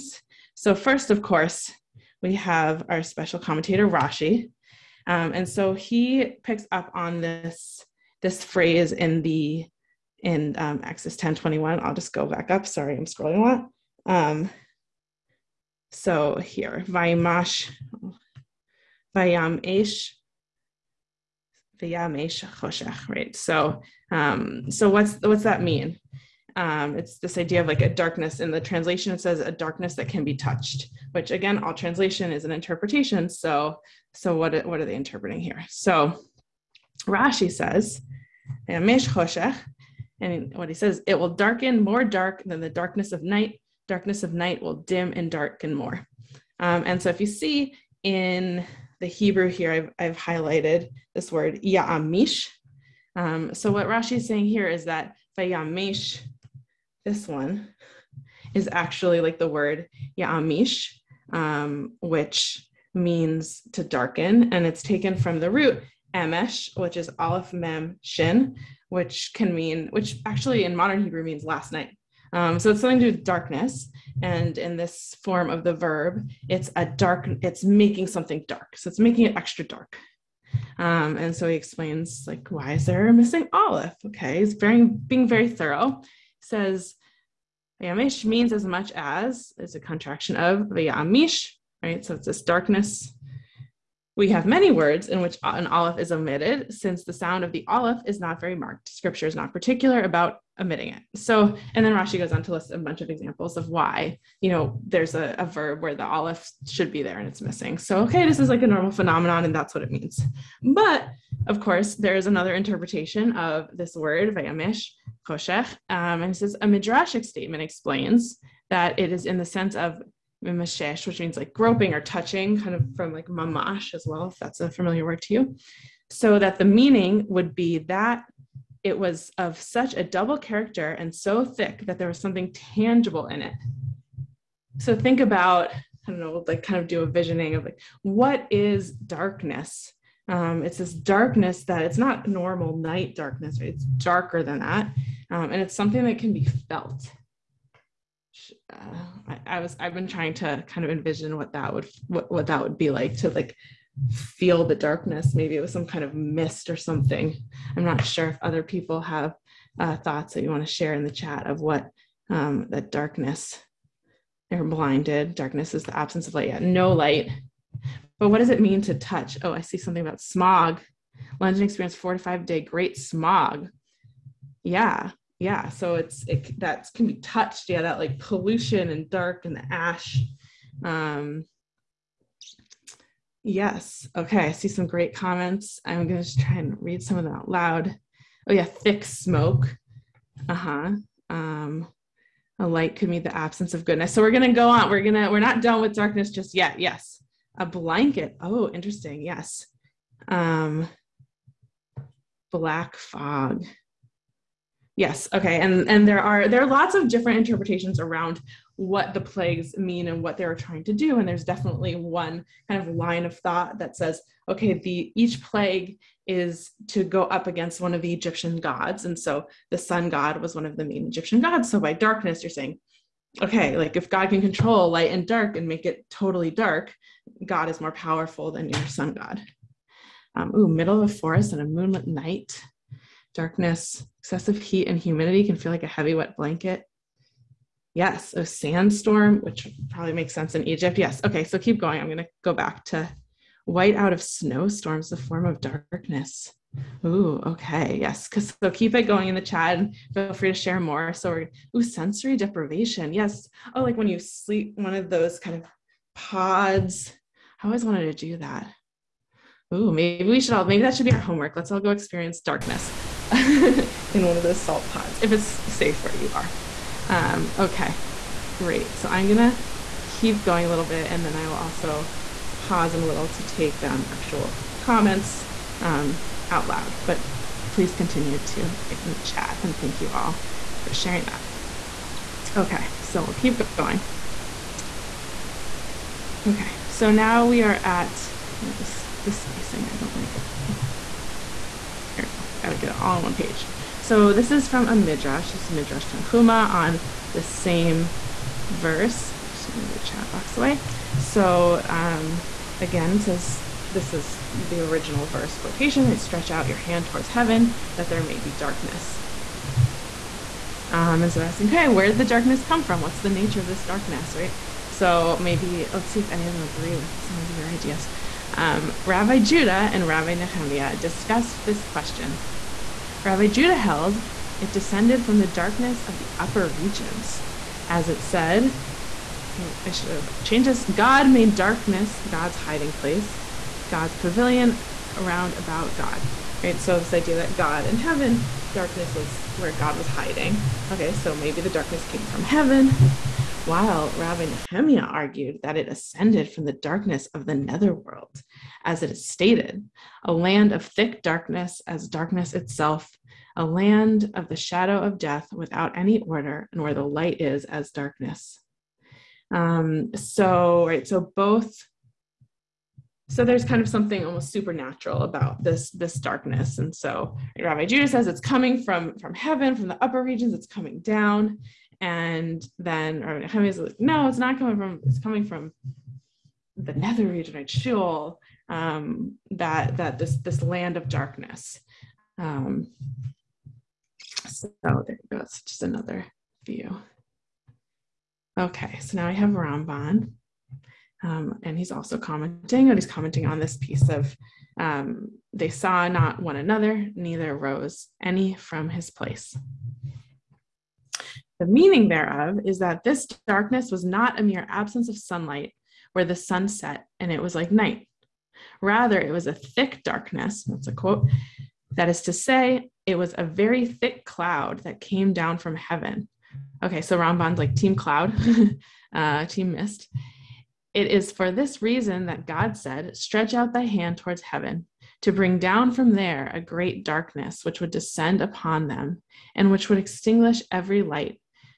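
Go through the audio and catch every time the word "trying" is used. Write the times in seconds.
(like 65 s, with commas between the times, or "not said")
150 s, 210 s.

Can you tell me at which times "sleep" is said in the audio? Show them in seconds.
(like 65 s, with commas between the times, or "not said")
254 s.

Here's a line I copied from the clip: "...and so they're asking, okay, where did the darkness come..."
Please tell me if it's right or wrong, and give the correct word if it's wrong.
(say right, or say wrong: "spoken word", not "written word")
right.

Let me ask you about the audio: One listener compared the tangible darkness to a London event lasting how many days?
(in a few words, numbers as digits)
four to five.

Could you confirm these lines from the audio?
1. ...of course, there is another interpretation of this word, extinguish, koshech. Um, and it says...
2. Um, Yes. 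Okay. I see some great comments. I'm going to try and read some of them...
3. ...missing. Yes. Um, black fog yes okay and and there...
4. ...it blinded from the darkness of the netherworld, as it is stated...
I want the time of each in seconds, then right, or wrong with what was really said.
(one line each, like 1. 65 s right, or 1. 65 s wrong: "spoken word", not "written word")
1. 111 s wrong: "vayamish", not "extinguish"
2. 180 s right
3. 198 s wrong: "interesting", not "missing"
4. 345 s wrong: "ascended", not "blinded".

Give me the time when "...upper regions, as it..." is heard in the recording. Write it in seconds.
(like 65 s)
326 s.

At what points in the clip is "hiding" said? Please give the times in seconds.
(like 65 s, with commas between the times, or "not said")
332 s, 340 s.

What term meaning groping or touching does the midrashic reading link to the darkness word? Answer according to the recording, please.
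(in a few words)
mimashesh.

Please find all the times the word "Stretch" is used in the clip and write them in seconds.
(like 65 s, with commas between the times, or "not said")
306 s, 423 s.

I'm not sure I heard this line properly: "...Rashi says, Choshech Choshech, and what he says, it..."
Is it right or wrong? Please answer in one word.
wrong.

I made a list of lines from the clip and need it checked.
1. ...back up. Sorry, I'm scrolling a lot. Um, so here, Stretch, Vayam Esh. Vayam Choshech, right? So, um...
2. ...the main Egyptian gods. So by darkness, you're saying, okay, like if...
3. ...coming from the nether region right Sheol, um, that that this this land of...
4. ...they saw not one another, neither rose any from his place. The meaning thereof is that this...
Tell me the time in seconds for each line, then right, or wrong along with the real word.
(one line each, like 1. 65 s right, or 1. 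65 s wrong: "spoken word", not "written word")
1. 12 s wrong: "Vaimash", not "Stretch"
2. 220 s right
3. 375 s right
4. 395 s right.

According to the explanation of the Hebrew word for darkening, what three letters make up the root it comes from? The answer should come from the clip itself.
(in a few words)
aleph mem shin.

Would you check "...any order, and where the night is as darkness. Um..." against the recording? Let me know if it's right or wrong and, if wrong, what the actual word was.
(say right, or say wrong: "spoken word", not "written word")
wrong: "light", not "night".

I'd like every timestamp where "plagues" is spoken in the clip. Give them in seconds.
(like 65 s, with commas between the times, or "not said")
209 s, 215 s.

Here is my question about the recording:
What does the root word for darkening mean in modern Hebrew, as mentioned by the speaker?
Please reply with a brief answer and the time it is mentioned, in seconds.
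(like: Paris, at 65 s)
last night, at 71 s.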